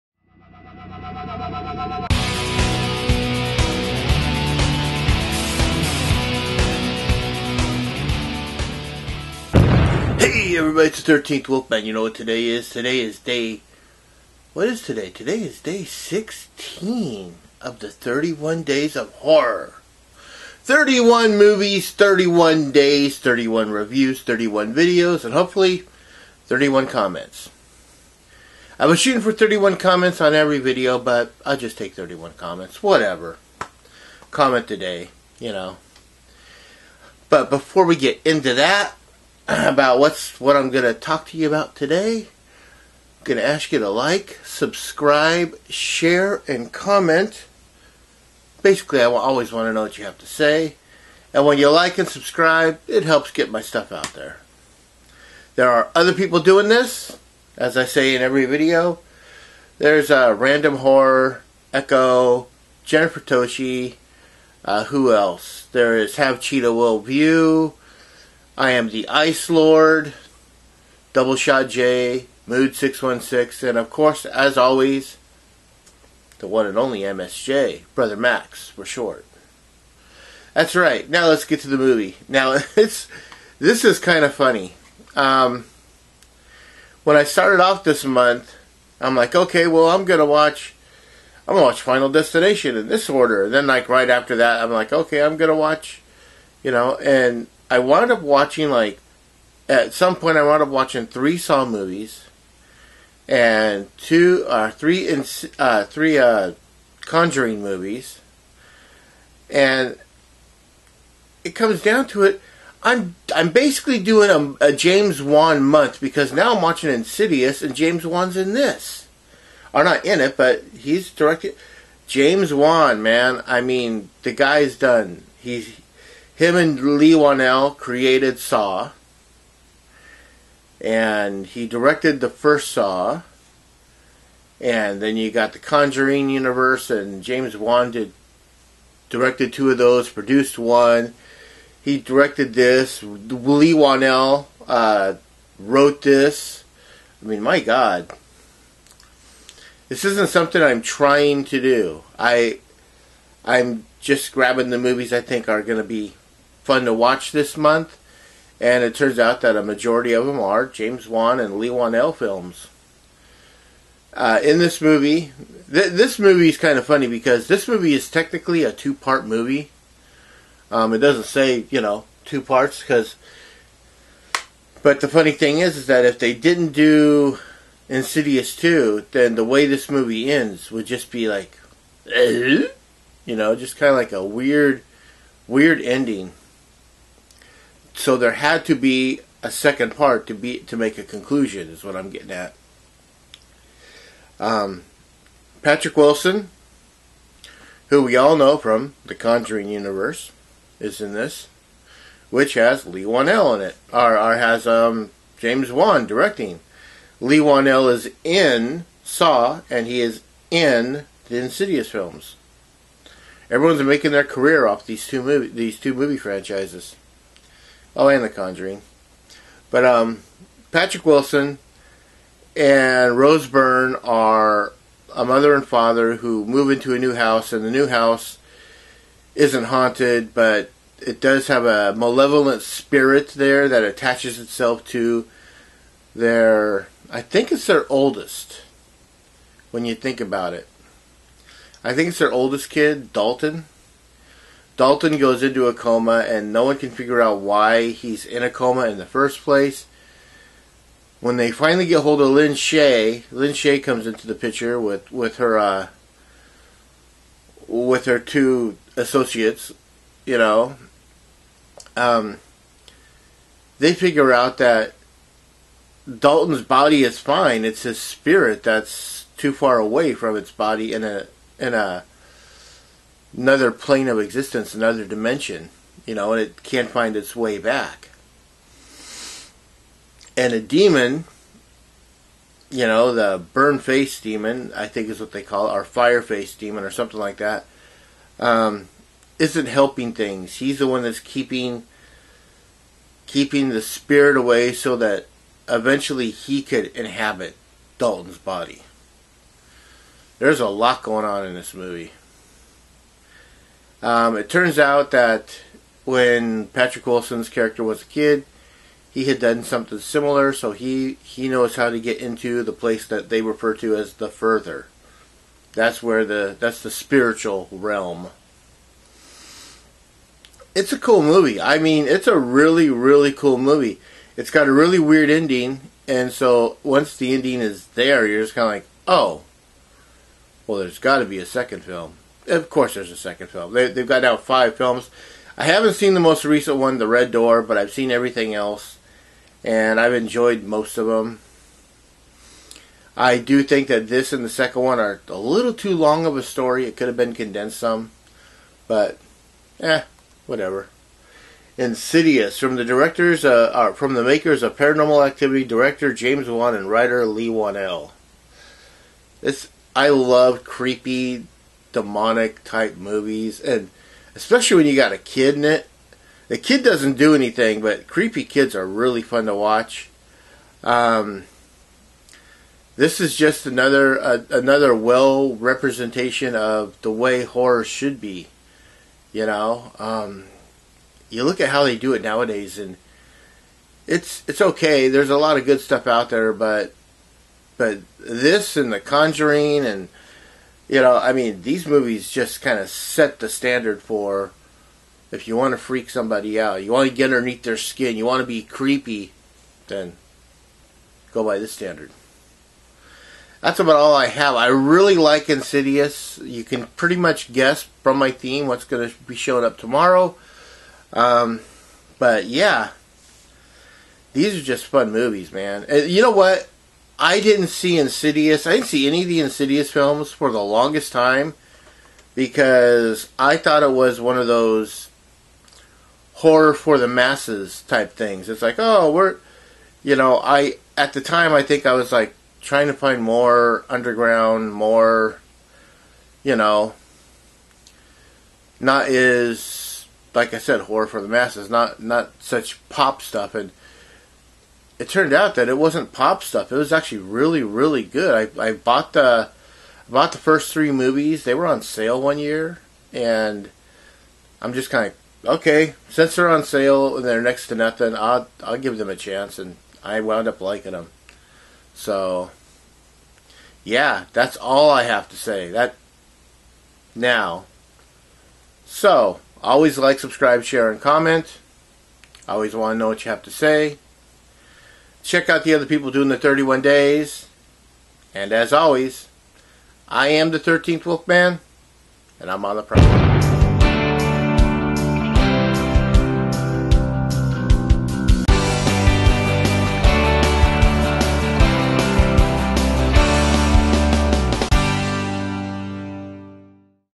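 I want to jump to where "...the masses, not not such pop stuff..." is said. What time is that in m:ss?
7:21.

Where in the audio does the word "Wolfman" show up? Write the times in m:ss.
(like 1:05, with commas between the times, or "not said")
0:11, 8:01.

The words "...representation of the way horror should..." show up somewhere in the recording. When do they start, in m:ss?
6:15.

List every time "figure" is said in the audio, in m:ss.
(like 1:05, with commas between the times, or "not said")
4:06, 4:23.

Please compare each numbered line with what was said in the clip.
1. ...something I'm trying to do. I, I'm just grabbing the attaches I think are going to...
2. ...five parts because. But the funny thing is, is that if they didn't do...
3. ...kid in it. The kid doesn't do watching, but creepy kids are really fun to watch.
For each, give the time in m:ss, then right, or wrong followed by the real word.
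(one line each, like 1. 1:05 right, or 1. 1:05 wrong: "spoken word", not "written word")
1. 2:30 wrong: "movies", not "attaches"
2. 2:52 wrong: "two", not "five"
3. 6:05 wrong: "anything", not "watching".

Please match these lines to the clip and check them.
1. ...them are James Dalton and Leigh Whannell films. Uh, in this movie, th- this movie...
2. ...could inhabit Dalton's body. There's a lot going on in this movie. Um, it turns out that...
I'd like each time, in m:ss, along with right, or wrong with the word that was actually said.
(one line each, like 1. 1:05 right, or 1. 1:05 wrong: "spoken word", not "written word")
1. 2:40 wrong: "Wan", not "Dalton"
2. 4:56 right.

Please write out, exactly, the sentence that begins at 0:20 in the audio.
31 movies, 31 days, 31 reviews, 31 videos, and hopefully 31 comments.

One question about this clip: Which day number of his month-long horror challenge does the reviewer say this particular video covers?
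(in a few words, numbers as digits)
16.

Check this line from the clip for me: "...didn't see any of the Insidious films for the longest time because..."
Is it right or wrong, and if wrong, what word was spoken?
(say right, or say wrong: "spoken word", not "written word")
right.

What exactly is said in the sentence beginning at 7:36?
Since they're on sale and they're next to nothing, I'll I'll give them a chance, and I wound up liking them.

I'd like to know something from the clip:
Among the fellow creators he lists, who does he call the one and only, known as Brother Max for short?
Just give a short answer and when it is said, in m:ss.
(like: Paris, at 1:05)
MSJ, at 1:17.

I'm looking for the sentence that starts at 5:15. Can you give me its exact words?
That's where the that's the spiritual realm.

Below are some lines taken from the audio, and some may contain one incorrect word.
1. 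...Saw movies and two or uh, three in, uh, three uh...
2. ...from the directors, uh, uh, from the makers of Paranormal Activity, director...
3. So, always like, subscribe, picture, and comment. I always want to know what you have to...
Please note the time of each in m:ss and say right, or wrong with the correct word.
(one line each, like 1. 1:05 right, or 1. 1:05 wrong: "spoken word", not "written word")
1. 1:41 right
2. 5:52 right
3. 7:48 wrong: "share", not "picture".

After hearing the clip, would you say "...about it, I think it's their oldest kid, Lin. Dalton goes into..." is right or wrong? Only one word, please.
wrong.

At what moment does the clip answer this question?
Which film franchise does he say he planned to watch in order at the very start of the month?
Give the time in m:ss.
1:31.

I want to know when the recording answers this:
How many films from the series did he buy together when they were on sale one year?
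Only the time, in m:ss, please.
7:30.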